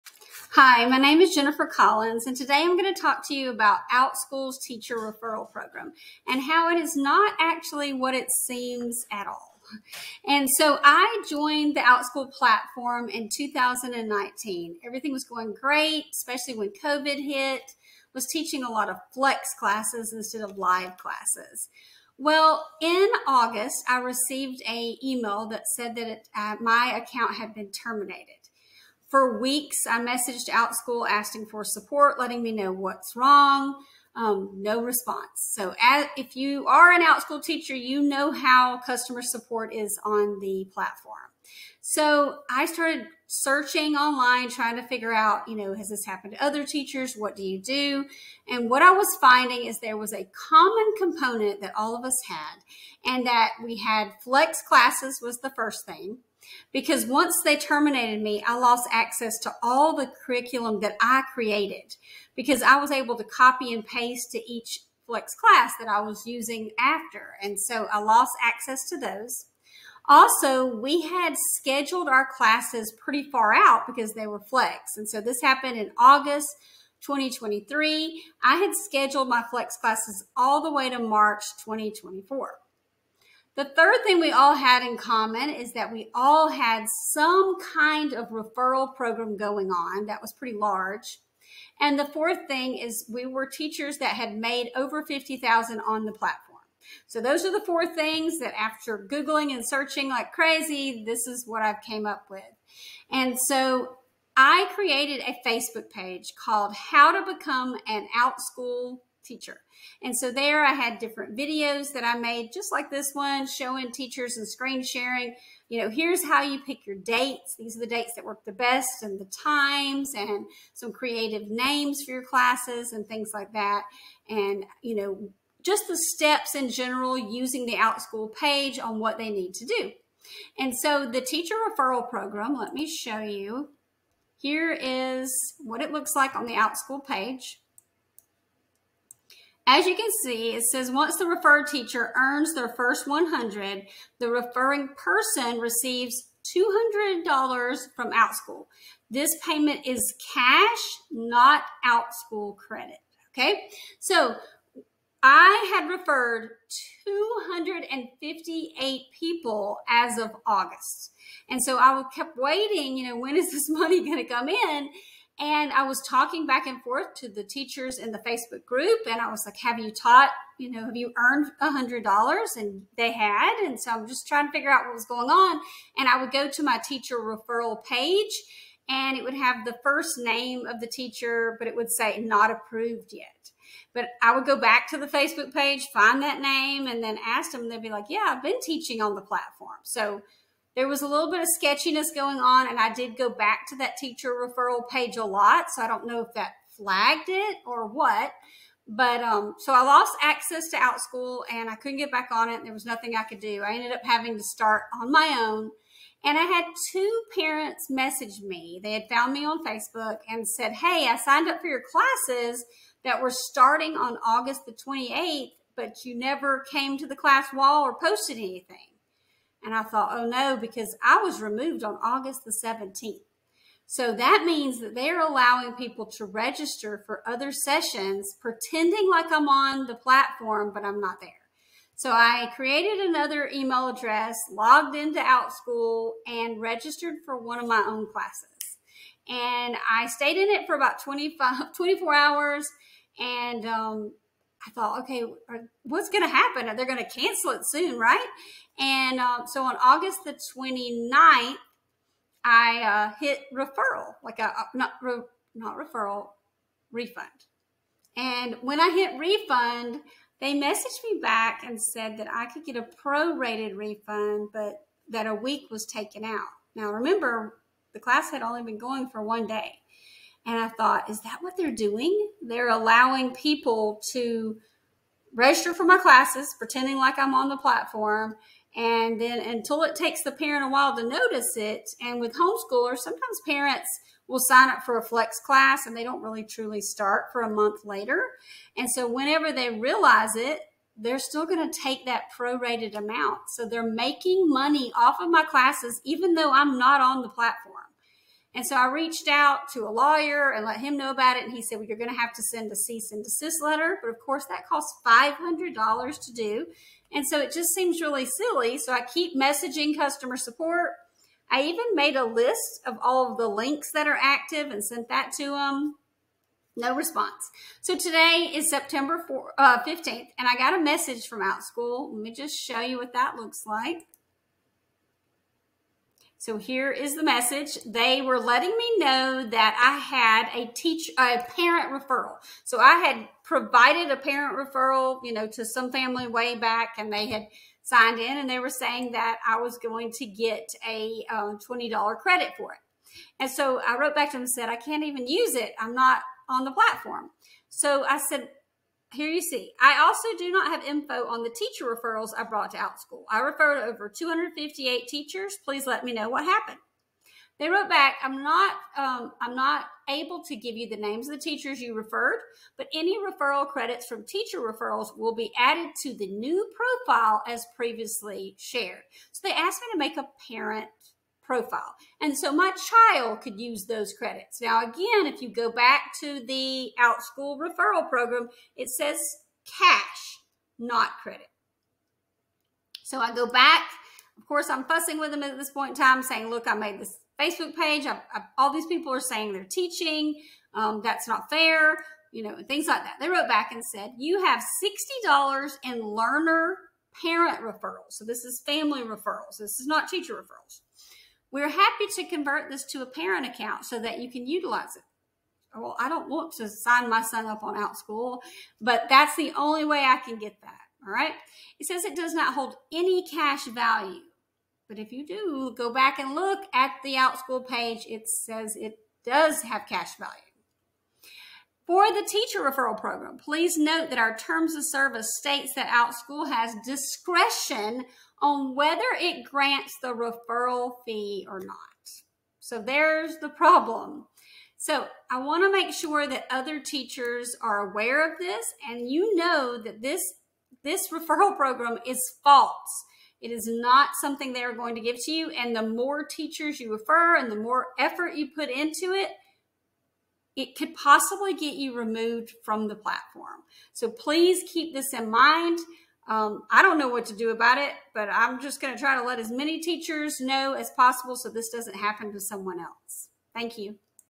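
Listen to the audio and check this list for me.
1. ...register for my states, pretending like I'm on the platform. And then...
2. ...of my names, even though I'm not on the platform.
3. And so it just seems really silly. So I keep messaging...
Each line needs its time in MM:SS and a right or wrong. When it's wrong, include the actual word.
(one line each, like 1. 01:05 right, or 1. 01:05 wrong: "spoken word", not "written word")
1. 04:35 wrong: "classes", not "states"
2. 04:55 wrong: "classes", not "names"
3. 05:07 right.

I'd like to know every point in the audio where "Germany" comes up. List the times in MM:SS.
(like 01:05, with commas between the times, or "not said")
not said.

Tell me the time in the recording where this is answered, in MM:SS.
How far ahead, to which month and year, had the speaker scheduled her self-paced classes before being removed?
01:20.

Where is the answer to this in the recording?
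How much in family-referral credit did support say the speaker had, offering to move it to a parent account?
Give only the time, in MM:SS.
06:35.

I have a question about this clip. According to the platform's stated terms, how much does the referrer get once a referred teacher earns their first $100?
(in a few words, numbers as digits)
$200.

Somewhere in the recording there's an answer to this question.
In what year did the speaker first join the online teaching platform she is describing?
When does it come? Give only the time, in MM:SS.
00:13.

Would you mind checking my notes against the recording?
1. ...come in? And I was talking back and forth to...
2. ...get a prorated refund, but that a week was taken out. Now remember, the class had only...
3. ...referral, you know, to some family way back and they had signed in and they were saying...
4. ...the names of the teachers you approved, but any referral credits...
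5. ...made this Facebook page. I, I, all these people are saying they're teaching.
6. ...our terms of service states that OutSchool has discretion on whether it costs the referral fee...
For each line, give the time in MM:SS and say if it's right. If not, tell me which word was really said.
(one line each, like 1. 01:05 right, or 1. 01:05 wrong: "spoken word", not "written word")
1. 02:44 right
2. 04:22 right
3. 05:34 right
4. 06:00 wrong: "referred", not "approved"
5. 06:26 right
6. 07:04 wrong: "grants", not "costs".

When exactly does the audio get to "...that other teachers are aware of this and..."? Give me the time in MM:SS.
07:16.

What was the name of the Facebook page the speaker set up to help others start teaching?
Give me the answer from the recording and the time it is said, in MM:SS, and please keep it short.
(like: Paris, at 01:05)
How to Become an Outschool teacher, at 01:46.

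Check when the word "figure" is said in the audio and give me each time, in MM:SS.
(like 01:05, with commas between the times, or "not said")
00:44, 02:54.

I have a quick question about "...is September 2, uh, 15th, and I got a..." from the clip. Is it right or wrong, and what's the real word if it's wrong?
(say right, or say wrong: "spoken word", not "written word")
wrong: "4", not "2".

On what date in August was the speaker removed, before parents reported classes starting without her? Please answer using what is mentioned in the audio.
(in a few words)
August 17.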